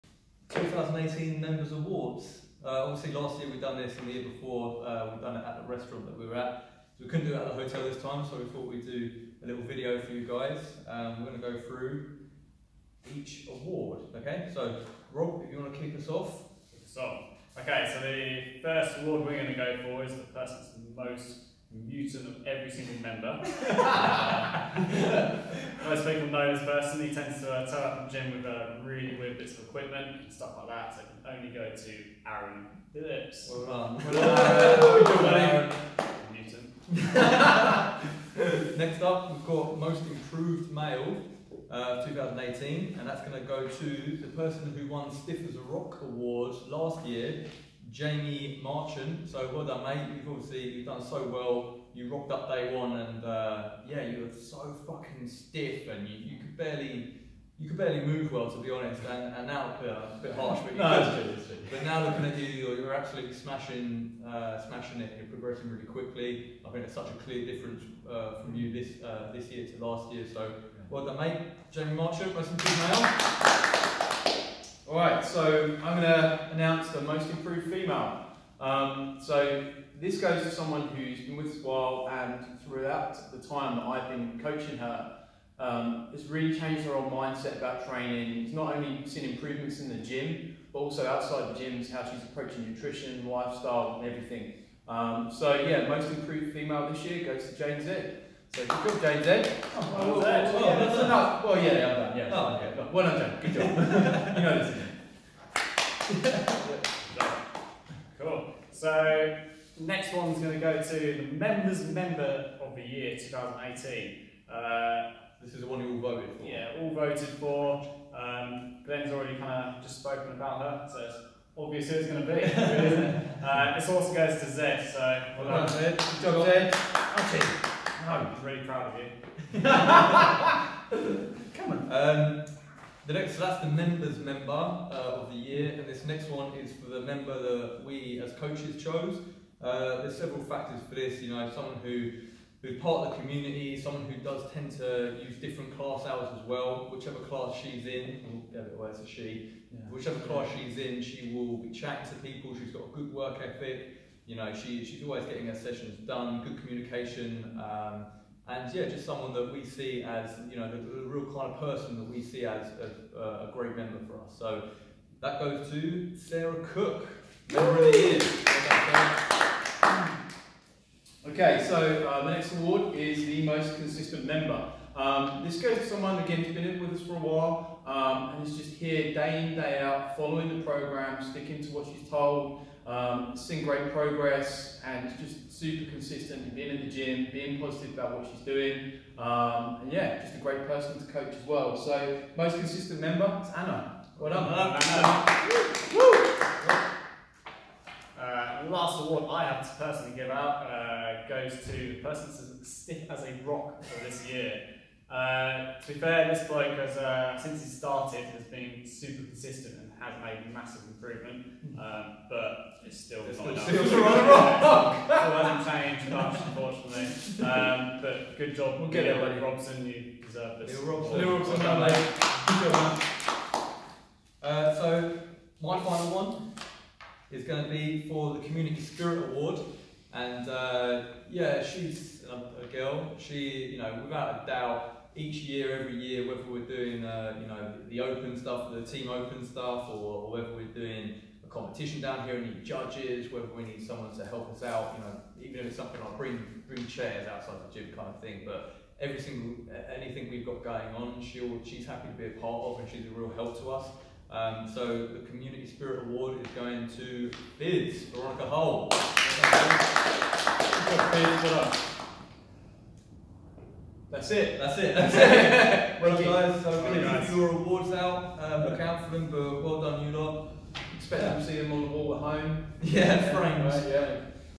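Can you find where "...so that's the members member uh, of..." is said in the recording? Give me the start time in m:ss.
2:13.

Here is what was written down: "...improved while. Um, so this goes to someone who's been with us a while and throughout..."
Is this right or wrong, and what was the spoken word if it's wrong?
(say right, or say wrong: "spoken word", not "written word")
wrong: "female", not "while".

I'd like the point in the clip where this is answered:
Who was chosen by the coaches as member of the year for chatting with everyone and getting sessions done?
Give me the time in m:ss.
2:46.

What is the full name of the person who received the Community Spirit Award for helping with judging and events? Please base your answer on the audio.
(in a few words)
Veronica Hull.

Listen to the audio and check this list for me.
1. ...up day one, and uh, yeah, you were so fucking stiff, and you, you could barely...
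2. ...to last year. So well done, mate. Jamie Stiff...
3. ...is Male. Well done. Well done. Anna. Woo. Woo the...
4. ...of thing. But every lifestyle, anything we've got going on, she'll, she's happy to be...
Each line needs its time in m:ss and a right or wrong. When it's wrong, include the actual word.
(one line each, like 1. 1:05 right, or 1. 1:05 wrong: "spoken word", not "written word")
1. 0:52 right
2. 1:09 wrong: "Marchant", not "Stiff"
3. 3:13 wrong: "Anna", not "Male"
4. 4:08 wrong: "single", not "lifestyle".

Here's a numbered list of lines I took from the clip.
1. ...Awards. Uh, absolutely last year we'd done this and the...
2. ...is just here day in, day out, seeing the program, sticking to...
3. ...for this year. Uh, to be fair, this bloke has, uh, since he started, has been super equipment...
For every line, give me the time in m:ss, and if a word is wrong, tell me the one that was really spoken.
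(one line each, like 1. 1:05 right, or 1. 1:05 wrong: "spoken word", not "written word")
1. 0:01 wrong: "obviously", not "absolutely"
2. 2:58 wrong: "following", not "seeing"
3. 3:23 wrong: "consistent", not "equipment".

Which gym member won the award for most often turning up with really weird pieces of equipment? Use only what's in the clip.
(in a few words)
Aaron Phillips.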